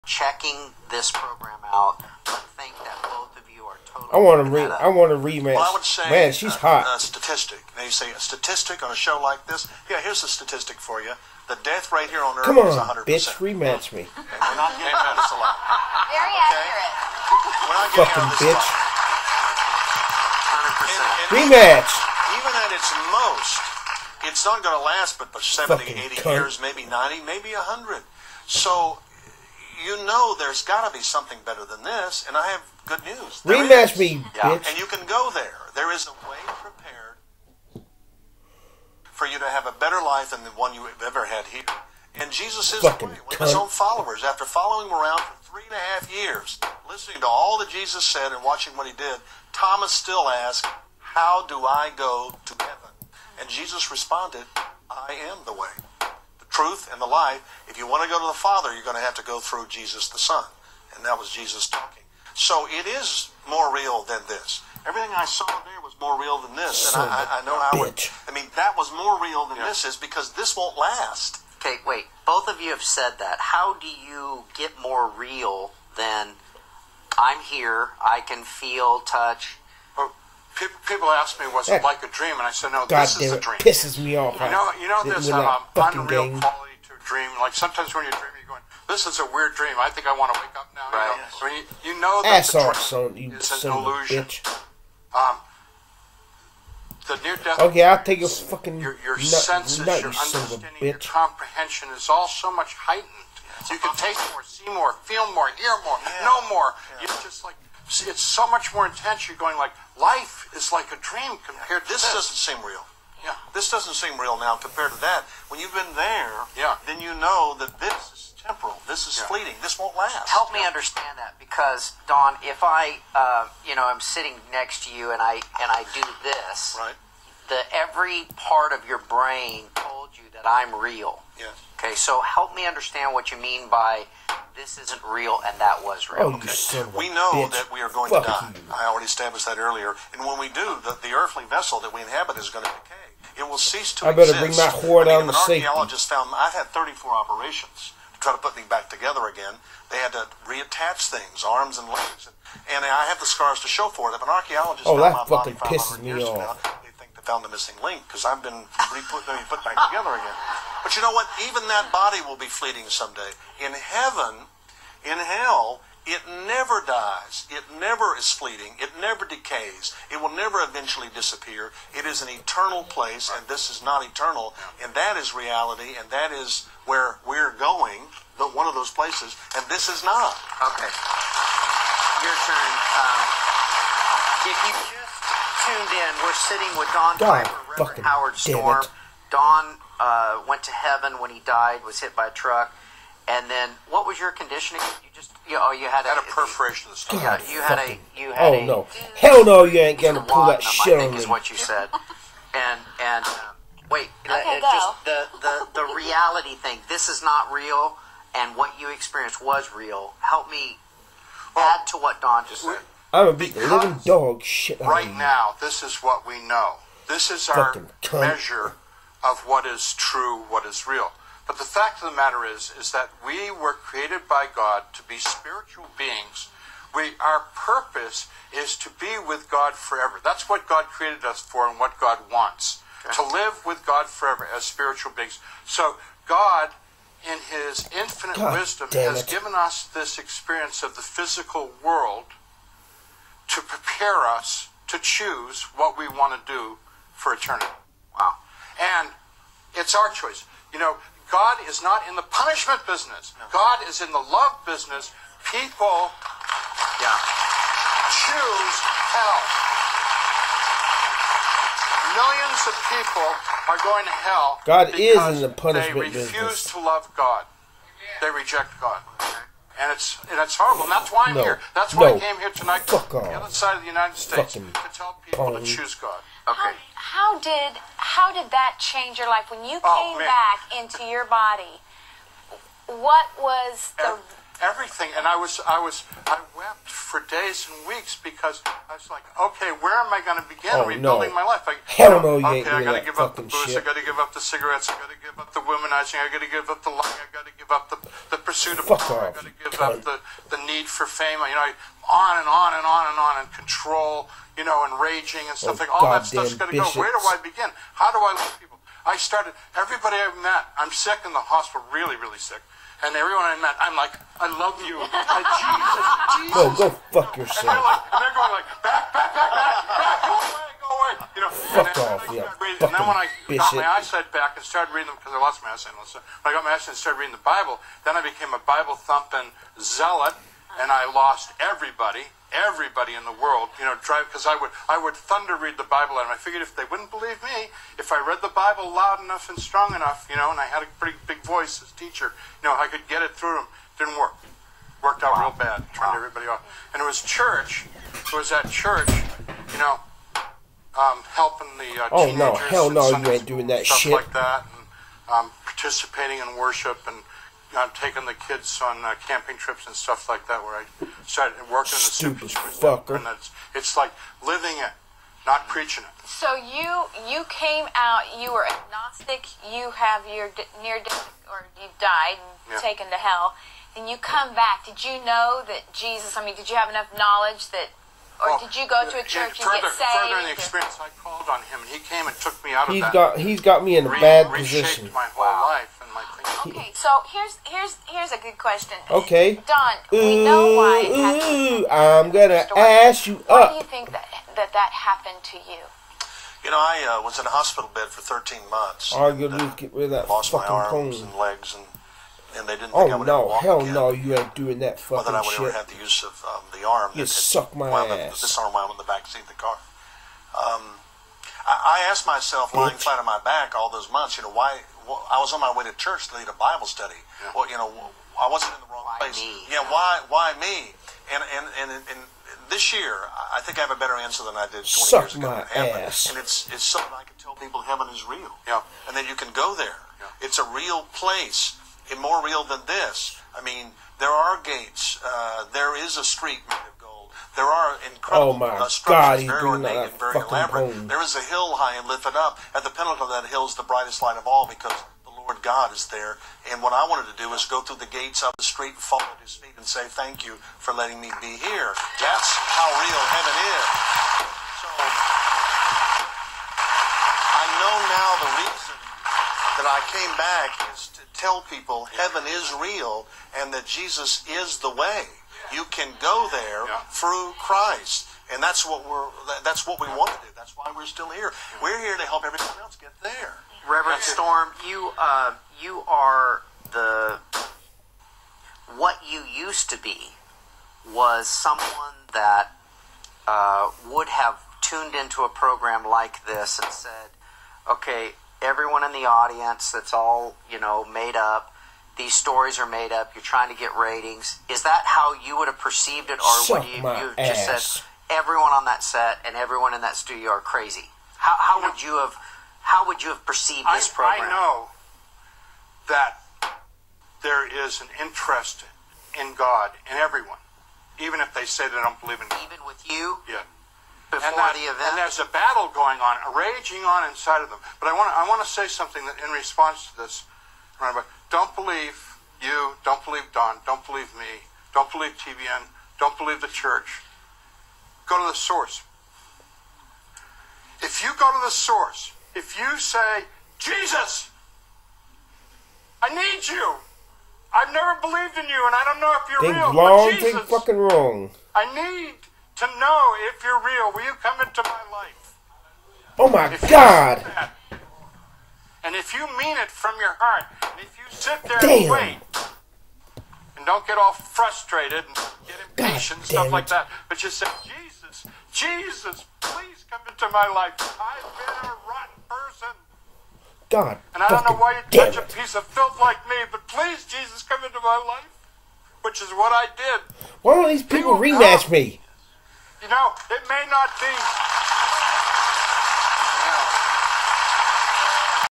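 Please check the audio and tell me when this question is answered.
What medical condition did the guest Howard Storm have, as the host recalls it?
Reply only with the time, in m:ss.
3:16.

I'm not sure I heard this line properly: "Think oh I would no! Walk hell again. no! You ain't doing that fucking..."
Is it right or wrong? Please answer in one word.
right.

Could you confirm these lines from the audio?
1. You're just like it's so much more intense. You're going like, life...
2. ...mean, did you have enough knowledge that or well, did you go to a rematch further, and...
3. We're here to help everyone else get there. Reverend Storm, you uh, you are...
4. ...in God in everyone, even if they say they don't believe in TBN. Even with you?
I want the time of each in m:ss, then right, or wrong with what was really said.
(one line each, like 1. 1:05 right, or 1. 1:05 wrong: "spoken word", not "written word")
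1. 1:47 right
2. 6:16 wrong: "church", not "rematch"
3. 7:51 right
4. 8:29 wrong: "God", not "TBN".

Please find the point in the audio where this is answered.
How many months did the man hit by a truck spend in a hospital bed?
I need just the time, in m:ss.
6:38.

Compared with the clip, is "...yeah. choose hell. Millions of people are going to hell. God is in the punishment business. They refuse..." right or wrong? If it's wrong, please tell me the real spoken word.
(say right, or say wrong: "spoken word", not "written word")
right.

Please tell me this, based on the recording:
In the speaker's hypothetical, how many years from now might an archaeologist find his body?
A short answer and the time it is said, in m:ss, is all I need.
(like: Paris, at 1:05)
500, at 2:35.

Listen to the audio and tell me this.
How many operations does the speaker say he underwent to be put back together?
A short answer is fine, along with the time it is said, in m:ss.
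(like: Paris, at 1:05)
34, at 2:26.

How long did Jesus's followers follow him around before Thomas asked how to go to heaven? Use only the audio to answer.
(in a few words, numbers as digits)
three and a half years.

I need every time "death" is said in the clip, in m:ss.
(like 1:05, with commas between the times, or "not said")
0:11, 1:37, 6:11.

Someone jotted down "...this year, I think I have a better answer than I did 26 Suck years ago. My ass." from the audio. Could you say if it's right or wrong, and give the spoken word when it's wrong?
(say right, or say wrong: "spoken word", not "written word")
wrong: "20", not "26".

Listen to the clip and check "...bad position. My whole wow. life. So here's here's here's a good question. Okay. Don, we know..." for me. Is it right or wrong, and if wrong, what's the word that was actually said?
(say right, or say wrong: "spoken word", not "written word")
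right.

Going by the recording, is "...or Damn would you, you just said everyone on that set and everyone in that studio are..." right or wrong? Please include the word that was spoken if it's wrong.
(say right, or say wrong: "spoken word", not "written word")
wrong: "Suck", not "Damn".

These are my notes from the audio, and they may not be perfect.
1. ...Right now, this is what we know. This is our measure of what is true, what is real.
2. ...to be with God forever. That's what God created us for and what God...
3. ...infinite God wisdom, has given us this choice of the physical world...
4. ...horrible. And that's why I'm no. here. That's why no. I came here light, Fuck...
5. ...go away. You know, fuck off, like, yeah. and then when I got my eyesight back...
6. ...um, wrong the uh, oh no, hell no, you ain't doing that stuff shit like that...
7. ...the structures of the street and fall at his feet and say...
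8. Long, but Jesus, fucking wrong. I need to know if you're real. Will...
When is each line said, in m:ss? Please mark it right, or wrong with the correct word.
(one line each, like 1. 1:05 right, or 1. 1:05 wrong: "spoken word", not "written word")
1. 3:34 right
2. 3:48 right
3. 3:57 wrong: "experience", not "choice"
4. 4:30 wrong: "tonight", not "light"
5. 5:20 right
6. 5:50 wrong: "helping", not "wrong"
7. 7:27 wrong: "gates", not "structures"
8. 8:59 right.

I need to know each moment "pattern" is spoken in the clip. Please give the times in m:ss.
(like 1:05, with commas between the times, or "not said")
not said.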